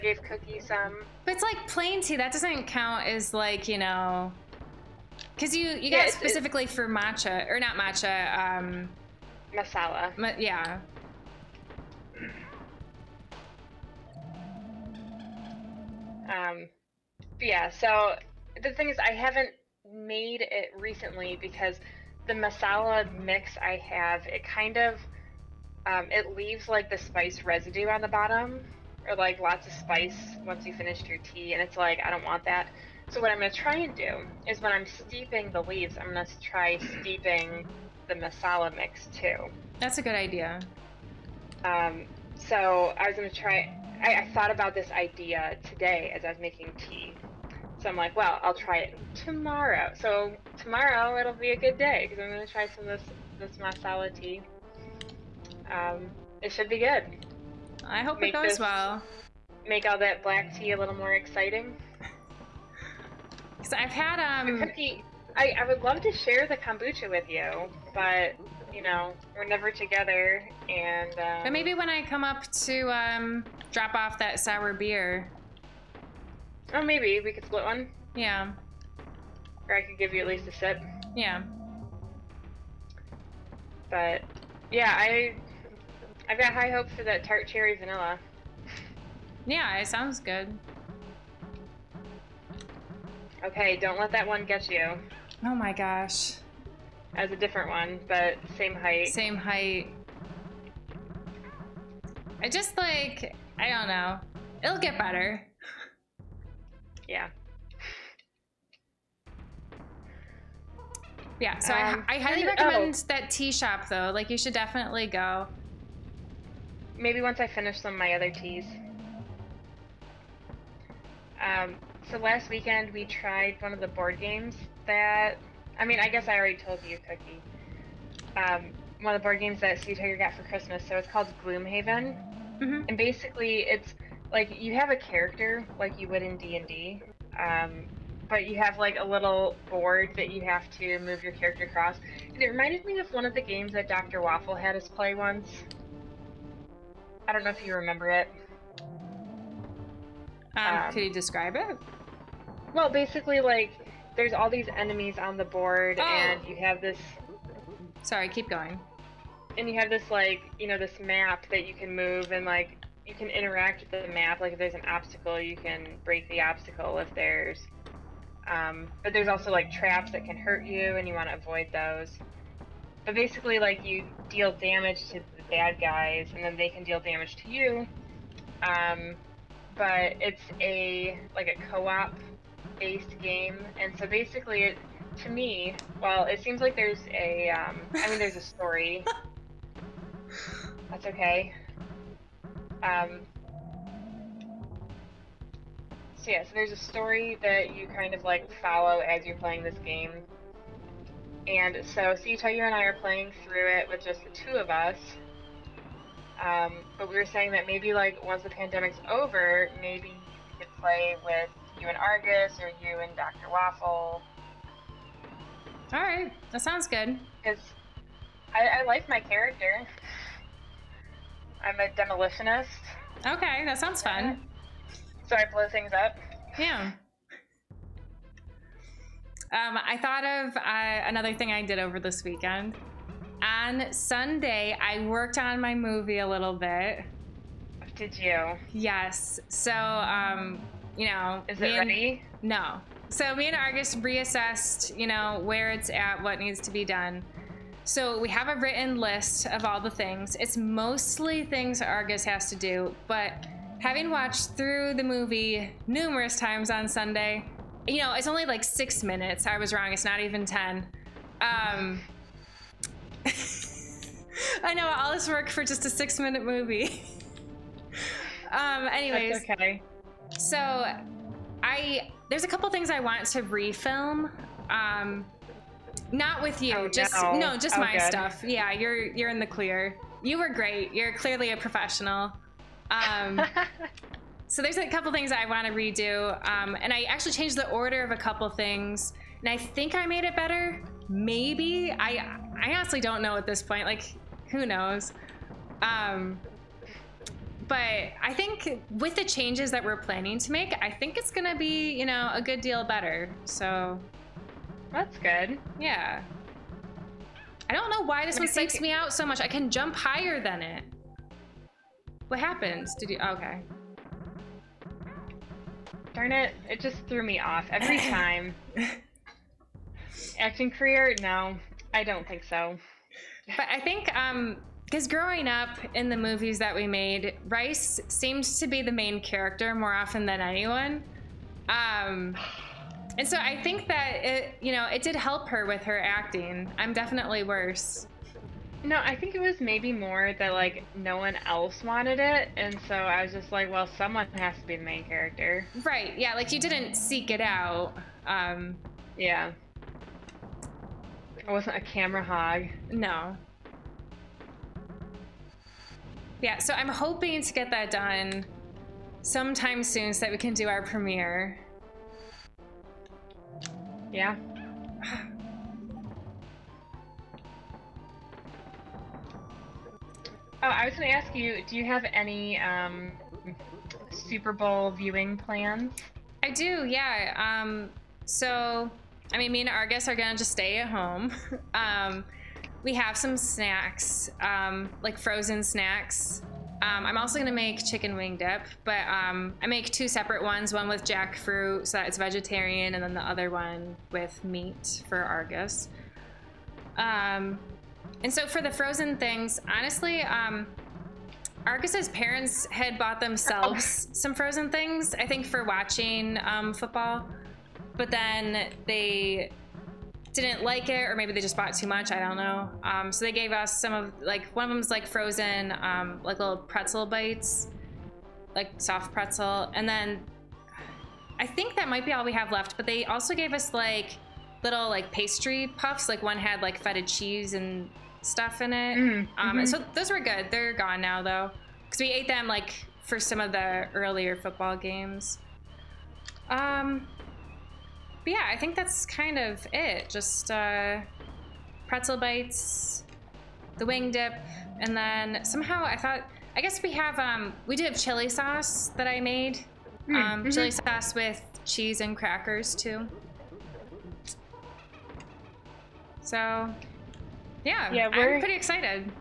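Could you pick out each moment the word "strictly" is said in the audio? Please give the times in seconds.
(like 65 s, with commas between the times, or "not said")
not said.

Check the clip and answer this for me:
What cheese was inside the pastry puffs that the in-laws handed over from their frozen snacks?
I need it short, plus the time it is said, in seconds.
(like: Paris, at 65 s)
Feta, at 426 s.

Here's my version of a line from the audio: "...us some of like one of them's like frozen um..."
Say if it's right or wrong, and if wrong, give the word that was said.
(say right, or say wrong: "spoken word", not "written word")
right.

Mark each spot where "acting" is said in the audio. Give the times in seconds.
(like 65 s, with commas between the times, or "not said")
320 s, 336 s.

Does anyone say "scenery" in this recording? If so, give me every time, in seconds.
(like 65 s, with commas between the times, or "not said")
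not said.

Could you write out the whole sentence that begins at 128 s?
Um, one of the board games that Sea Tiger got for Christmas.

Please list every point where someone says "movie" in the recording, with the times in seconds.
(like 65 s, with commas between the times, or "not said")
235 s, 255 s, 266 s, 326 s.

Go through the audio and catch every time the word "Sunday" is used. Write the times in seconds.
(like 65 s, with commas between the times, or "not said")
233 s, 256 s.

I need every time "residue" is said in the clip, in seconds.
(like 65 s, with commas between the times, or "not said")
27 s.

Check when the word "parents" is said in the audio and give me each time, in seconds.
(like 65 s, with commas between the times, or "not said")
402 s.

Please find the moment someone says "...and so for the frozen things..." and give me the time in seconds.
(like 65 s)
398 s.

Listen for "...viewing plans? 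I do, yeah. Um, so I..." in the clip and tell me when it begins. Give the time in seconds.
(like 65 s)
374 s.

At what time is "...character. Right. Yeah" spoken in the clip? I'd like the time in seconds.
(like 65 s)
345 s.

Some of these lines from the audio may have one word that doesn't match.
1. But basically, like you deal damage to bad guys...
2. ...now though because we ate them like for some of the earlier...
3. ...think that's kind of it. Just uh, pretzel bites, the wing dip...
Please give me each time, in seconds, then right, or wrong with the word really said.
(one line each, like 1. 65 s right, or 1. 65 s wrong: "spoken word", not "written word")
1. 173 s right
2. 431 s right
3. 438 s right.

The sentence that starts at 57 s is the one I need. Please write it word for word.
I hope make it goes this, well.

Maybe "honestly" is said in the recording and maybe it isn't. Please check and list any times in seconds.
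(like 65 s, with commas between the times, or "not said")
292 s, 399 s.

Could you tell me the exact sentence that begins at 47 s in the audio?
So I'm like, well, I'll try it tomorrow.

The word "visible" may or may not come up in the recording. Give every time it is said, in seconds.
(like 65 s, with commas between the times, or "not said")
not said.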